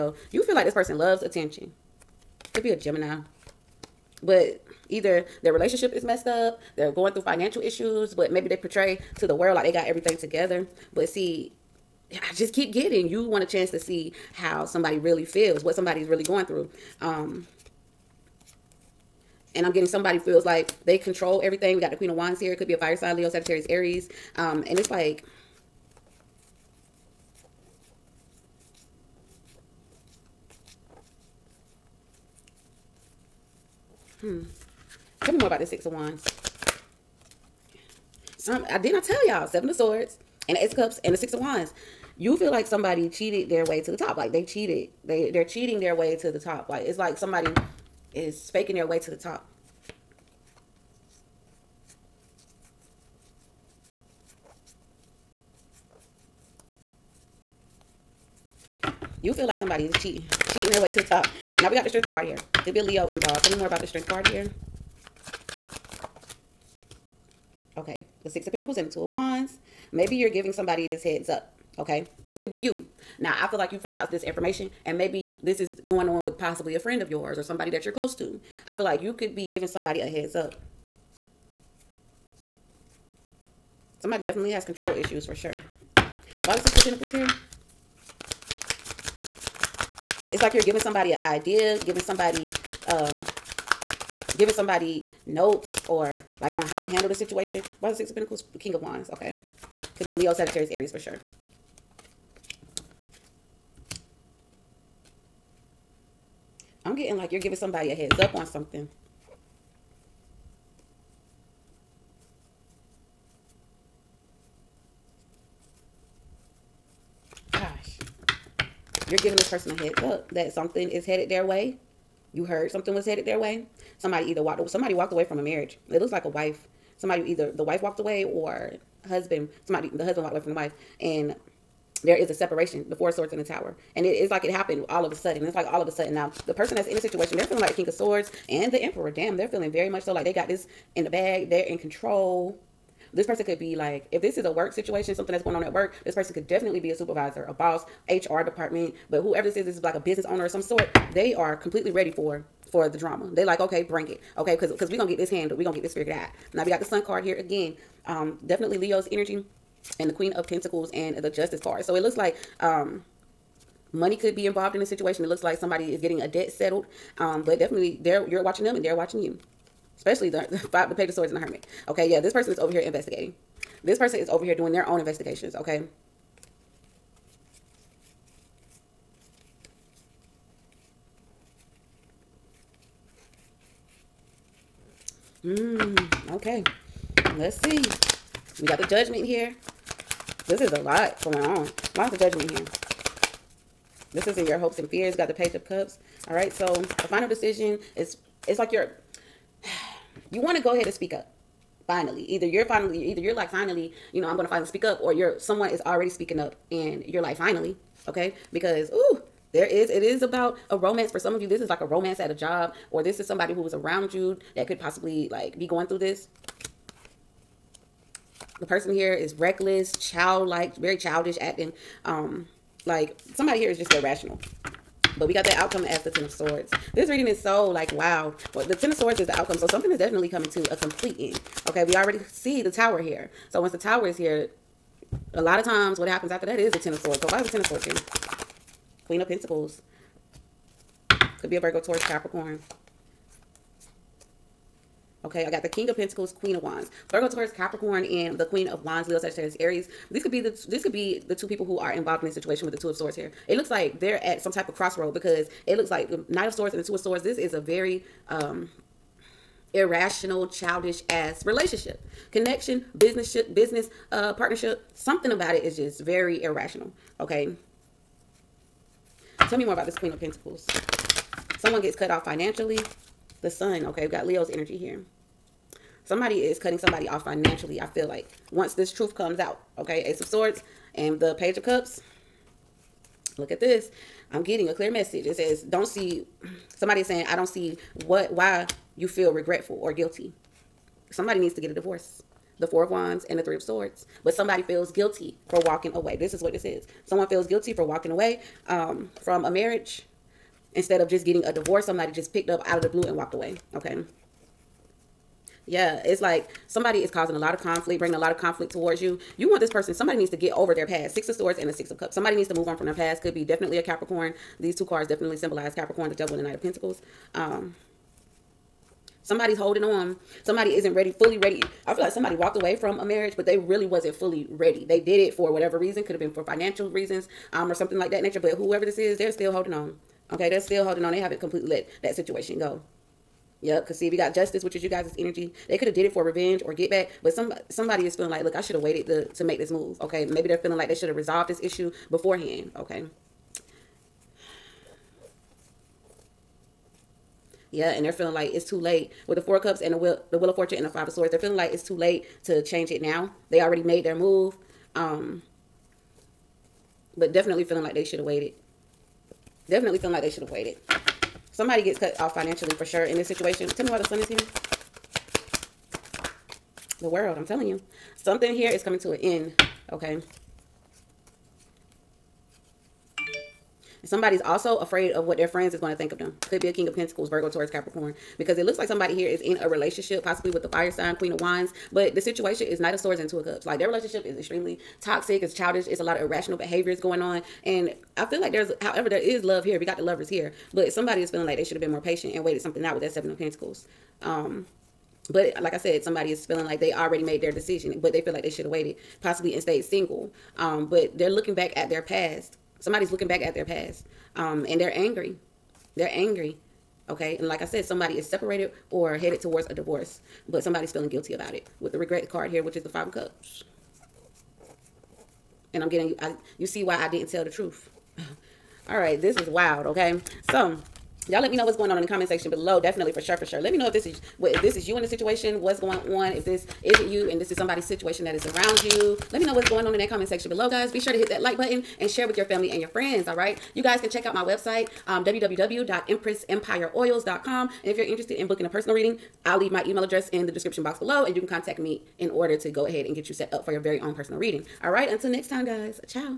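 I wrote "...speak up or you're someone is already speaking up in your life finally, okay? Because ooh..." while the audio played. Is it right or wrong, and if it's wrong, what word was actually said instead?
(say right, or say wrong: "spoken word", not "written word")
right.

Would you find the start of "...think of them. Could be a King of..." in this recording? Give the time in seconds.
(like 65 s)
375 s.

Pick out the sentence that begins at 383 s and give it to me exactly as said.
Like their relationship is extremely toxic.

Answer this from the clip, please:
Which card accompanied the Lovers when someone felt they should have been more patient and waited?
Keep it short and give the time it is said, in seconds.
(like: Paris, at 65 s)
Seven of Pentacles, at 393 s.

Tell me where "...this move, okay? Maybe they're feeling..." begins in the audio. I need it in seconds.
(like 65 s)
339 s.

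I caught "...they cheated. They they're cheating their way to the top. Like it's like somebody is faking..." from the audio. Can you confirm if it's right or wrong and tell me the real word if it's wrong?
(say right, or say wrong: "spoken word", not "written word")
right.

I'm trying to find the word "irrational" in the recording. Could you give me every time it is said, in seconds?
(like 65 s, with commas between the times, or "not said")
223 s, 259 s, 266 s, 386 s.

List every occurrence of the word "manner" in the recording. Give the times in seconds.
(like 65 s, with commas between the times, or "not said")
not said.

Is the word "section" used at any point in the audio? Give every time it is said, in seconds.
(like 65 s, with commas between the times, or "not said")
422 s, 430 s.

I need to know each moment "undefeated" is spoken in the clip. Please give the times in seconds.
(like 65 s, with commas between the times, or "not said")
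not said.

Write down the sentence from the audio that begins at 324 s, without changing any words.
They did it for whatever reason, could have been for financial reasons, um, or something like that nature.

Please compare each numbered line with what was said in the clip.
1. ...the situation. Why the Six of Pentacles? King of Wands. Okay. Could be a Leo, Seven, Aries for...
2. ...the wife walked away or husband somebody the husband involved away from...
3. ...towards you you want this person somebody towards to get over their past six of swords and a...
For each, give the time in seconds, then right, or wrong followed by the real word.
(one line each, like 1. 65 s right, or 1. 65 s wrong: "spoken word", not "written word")
1. 97 s wrong: "Sagittarius", not "Seven"
2. 127 s wrong: "walked", not "involved"
3. 308 s wrong: "needs", not "towards".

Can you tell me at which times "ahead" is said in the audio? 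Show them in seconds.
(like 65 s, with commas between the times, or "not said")
200 s, 442 s.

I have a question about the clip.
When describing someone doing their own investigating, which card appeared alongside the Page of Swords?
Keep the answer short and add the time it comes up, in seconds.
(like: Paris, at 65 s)
The Hermit, at 171 s.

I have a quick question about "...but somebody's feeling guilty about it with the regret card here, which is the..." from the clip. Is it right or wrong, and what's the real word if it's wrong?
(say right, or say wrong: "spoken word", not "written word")
right.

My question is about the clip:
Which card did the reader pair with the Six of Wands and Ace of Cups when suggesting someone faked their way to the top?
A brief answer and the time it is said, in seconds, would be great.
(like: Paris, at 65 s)
Seven of Swords, at 39 s.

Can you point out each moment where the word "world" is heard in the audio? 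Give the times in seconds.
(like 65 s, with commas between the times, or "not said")
9 s, 367 s.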